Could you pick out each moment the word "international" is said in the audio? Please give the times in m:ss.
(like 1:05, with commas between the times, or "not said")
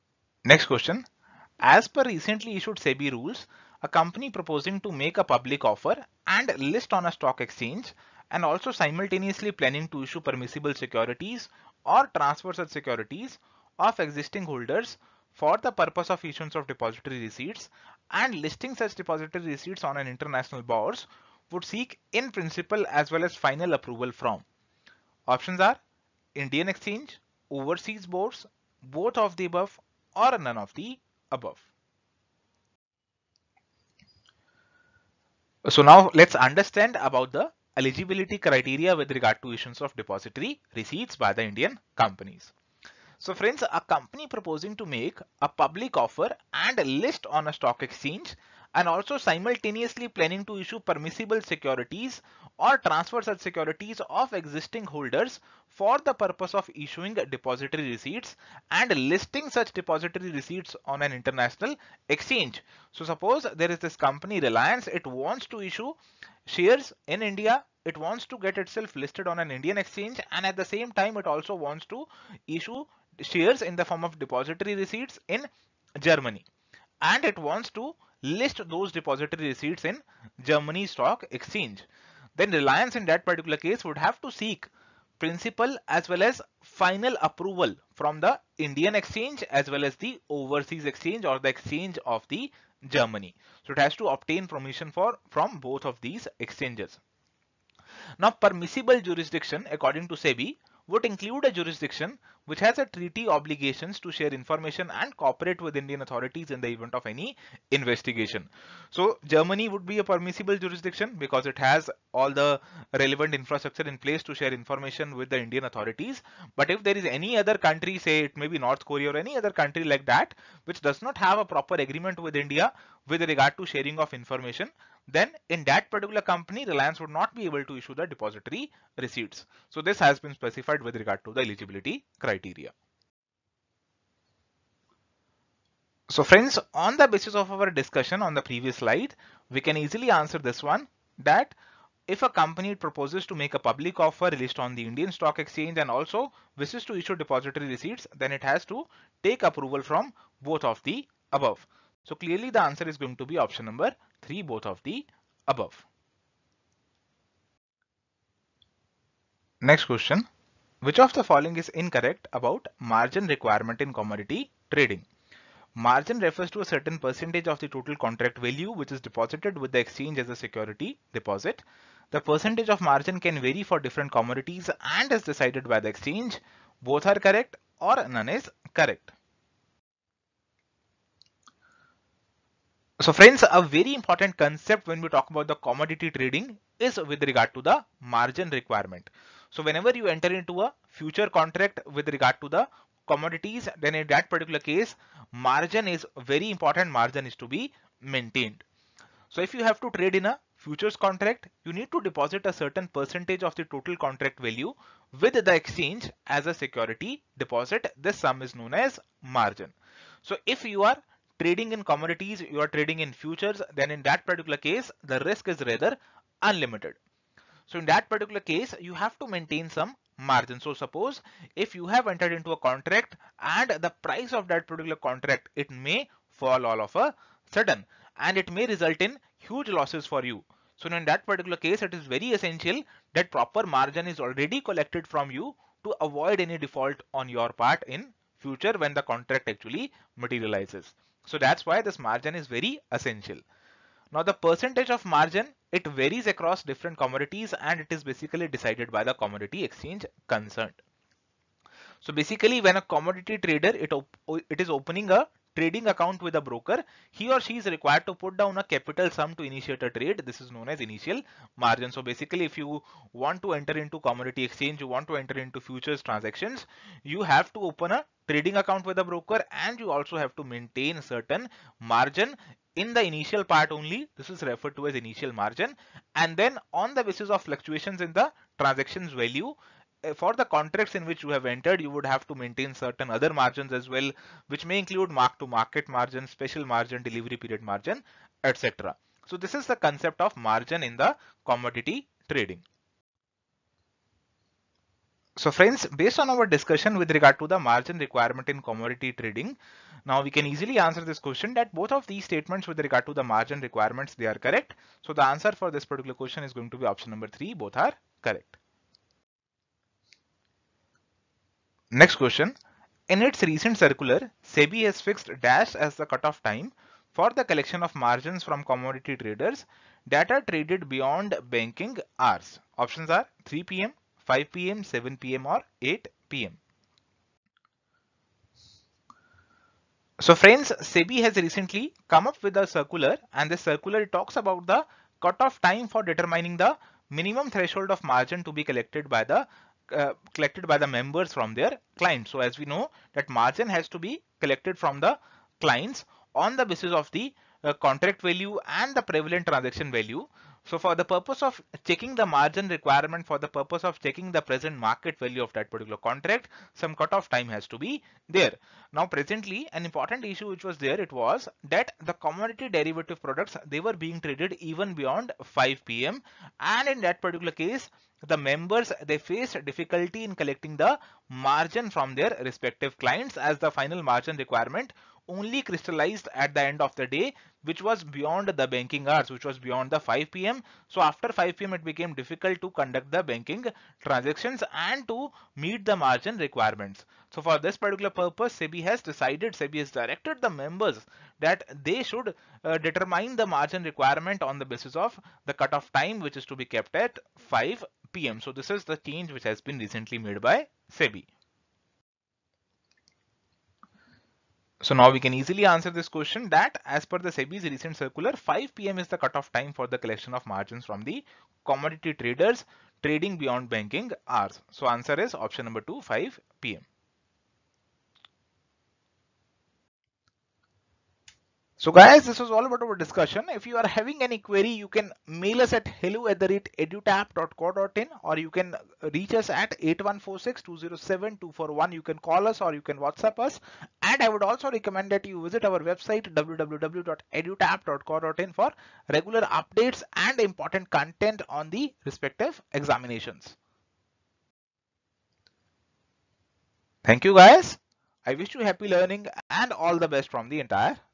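0:20, 1:01.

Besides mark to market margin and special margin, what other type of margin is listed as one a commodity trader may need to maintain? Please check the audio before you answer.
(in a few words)
Delivery period margin.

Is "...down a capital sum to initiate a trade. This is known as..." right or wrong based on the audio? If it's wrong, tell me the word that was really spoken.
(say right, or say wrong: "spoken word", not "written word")
right.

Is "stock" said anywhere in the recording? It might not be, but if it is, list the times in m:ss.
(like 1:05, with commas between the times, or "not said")
0:07, 0:47, 1:20, 2:25.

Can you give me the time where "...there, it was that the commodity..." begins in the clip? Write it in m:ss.
6:00.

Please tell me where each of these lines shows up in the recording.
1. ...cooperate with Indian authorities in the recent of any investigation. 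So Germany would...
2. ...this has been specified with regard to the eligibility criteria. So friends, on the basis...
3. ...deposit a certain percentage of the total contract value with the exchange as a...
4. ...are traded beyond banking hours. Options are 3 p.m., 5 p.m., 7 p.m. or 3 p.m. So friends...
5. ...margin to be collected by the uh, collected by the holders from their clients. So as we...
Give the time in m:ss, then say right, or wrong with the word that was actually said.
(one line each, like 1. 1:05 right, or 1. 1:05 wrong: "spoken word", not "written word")
1. 1:45 wrong: "event", not "recent"
2. 2:09 right
3. 3:22 right
4. 5:20 wrong: "8", not "3"
5. 5:38 wrong: "members", not "holders".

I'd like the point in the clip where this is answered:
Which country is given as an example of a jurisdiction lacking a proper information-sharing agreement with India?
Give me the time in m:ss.
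1:58.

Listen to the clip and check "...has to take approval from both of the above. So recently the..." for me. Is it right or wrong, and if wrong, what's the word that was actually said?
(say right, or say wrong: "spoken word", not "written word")
wrong: "clearly", not "recently".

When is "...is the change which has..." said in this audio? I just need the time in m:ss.
6:38.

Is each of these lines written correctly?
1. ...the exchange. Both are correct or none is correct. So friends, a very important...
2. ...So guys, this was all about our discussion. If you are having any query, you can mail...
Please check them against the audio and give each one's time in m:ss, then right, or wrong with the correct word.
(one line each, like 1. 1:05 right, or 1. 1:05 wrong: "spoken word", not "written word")
1. 2:55 right
2. 7:01 right.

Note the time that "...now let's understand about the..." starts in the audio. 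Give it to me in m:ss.
0:35.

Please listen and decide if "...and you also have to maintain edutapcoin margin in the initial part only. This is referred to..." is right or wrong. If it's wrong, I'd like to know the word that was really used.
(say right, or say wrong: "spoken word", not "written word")
wrong: "certain", not "edutapcoin".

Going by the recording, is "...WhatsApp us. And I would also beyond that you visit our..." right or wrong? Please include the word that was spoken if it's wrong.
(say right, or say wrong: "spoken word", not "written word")
wrong: "recommend", not "beyond".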